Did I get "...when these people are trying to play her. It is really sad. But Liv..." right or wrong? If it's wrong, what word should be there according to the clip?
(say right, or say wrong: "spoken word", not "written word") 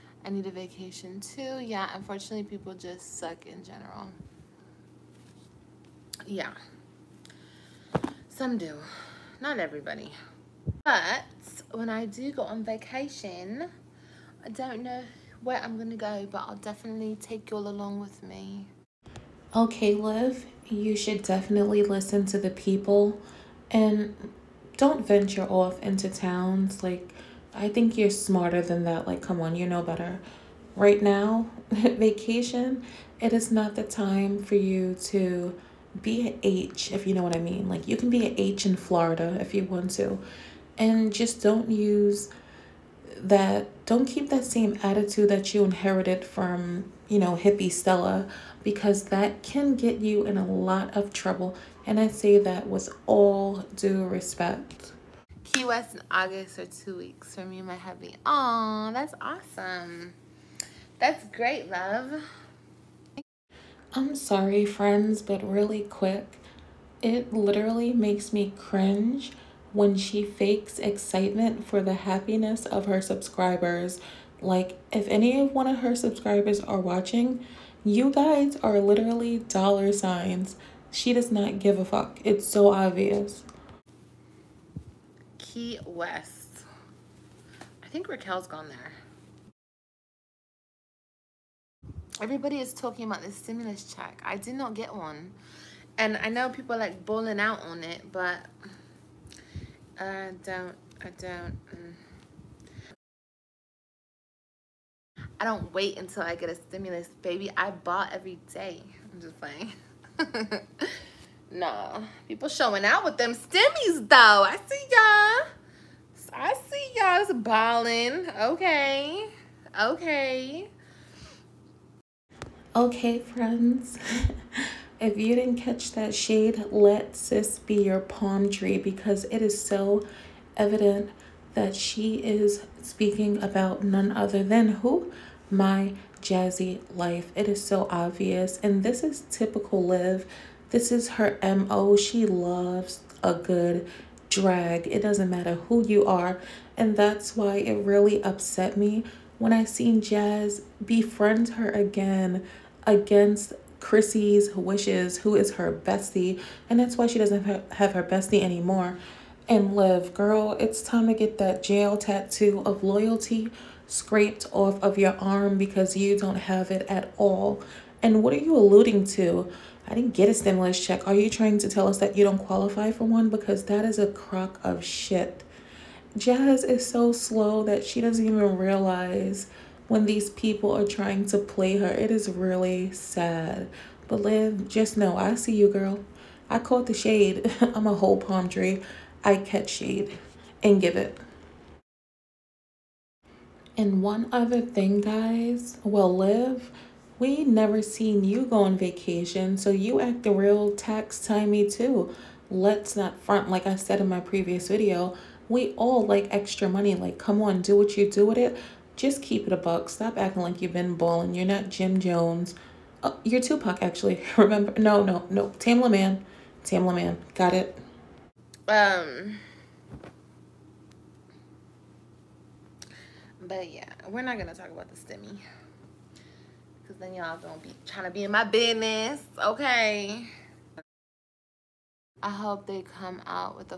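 right.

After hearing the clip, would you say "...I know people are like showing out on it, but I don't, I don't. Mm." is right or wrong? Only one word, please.
wrong.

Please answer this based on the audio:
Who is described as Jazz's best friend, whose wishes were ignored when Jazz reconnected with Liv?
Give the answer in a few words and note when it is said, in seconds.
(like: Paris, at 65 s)
Chrissy, at 153 s.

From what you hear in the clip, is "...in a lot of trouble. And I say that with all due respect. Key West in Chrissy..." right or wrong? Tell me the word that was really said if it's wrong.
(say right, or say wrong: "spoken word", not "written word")
wrong: "August", not "Chrissy".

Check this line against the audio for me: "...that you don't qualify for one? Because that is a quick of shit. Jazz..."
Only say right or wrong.
wrong.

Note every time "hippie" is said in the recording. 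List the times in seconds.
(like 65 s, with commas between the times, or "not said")
47 s.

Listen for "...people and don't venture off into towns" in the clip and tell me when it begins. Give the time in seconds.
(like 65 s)
22 s.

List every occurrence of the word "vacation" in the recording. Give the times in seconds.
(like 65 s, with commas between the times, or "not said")
0 s, 12 s, 31 s, 198 s.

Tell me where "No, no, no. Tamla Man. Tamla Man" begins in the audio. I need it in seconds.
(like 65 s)
214 s.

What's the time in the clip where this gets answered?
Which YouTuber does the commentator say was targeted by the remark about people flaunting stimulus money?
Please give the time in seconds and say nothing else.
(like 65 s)
135 s.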